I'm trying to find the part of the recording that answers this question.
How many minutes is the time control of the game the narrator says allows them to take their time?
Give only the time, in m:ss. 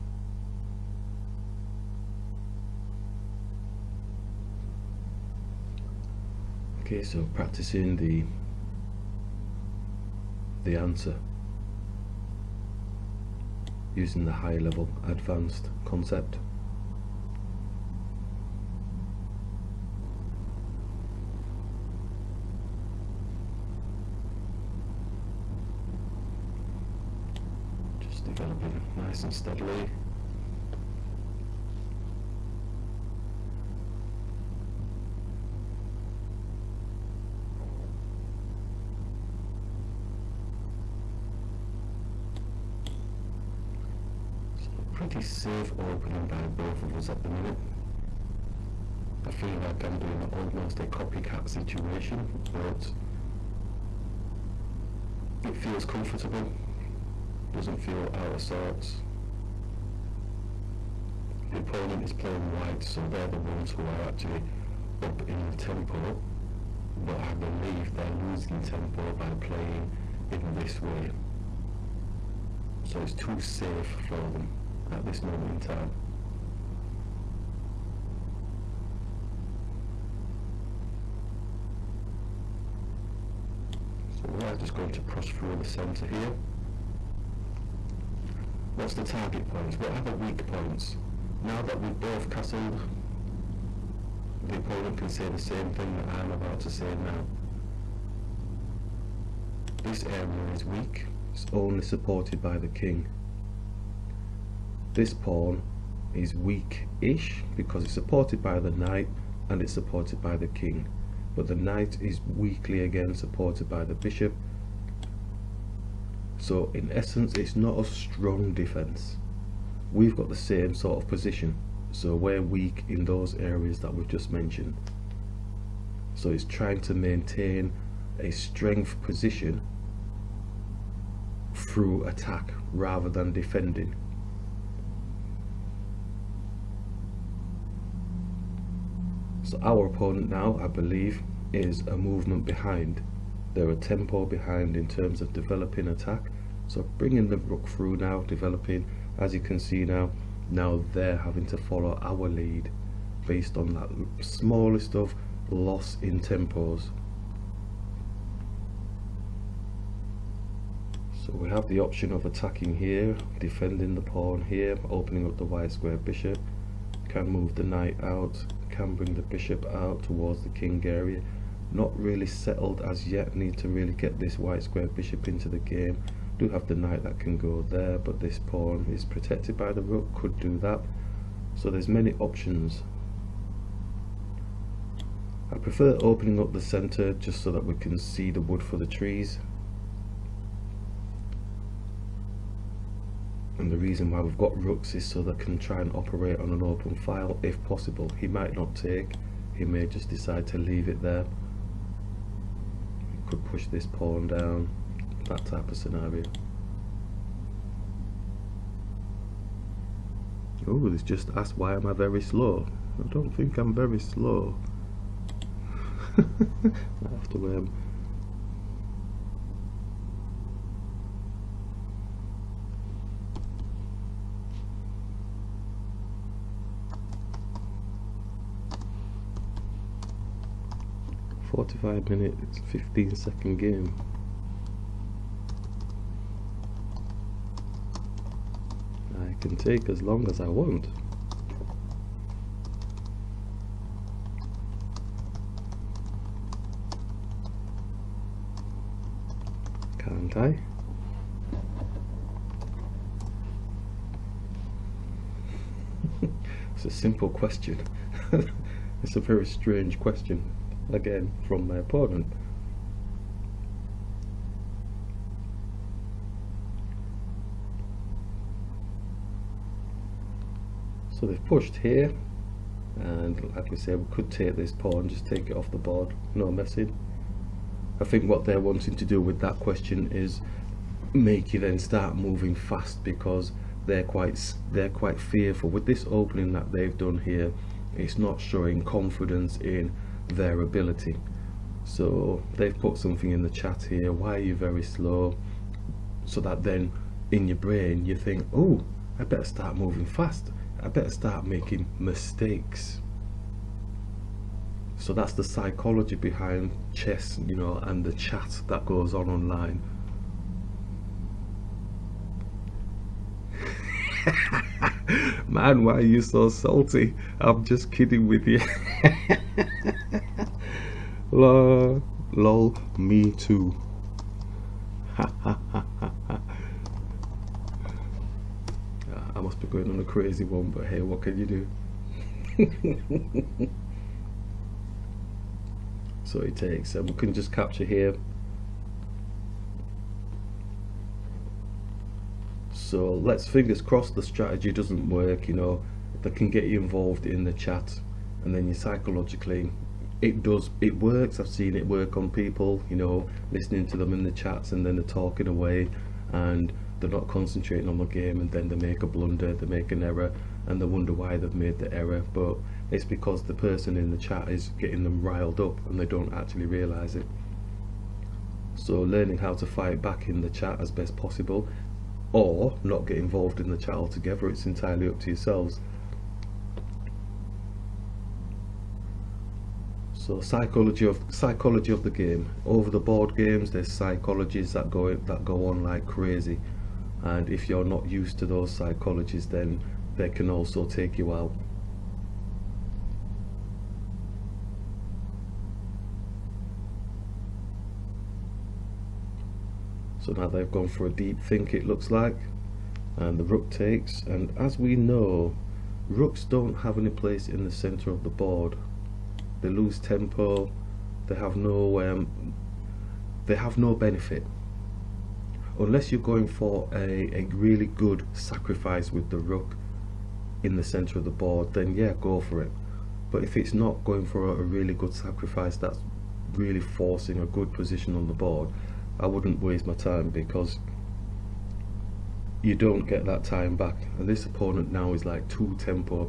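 3:51.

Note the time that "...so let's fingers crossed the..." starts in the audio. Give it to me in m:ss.
5:42.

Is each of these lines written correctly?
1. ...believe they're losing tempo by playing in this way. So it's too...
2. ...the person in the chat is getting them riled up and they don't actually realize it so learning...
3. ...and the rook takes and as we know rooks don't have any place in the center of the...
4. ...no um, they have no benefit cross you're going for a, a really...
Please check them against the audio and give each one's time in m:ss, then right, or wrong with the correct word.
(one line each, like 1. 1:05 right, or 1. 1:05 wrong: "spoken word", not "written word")
1. 1:07 right
2. 6:03 right
3. 6:43 right
4. 6:51 wrong: "unless", not "cross".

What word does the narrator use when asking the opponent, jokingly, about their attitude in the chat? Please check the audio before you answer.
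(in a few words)
Salty.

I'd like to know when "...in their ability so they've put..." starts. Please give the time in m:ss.
4:49.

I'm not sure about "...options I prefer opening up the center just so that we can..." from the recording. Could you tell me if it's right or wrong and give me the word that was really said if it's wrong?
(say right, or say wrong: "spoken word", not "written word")
right.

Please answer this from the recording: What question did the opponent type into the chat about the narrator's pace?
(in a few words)
Why am I very slow.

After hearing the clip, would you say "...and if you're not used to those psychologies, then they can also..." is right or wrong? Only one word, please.
right.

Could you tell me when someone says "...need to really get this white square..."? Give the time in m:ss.
2:53.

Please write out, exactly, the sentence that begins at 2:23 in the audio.
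They're a tempo behind in terms of developing attack.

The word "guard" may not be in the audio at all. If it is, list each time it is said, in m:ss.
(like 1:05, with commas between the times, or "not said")
not said.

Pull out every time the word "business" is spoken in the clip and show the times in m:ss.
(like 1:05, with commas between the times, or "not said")
not said.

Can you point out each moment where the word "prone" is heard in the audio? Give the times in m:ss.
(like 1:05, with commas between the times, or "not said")
not said.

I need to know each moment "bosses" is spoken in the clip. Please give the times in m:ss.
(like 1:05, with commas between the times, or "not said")
not said.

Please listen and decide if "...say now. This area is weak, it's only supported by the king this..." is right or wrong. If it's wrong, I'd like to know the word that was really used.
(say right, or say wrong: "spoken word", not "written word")
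right.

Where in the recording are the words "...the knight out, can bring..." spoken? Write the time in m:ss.
2:47.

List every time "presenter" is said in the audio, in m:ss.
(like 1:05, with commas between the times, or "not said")
not said.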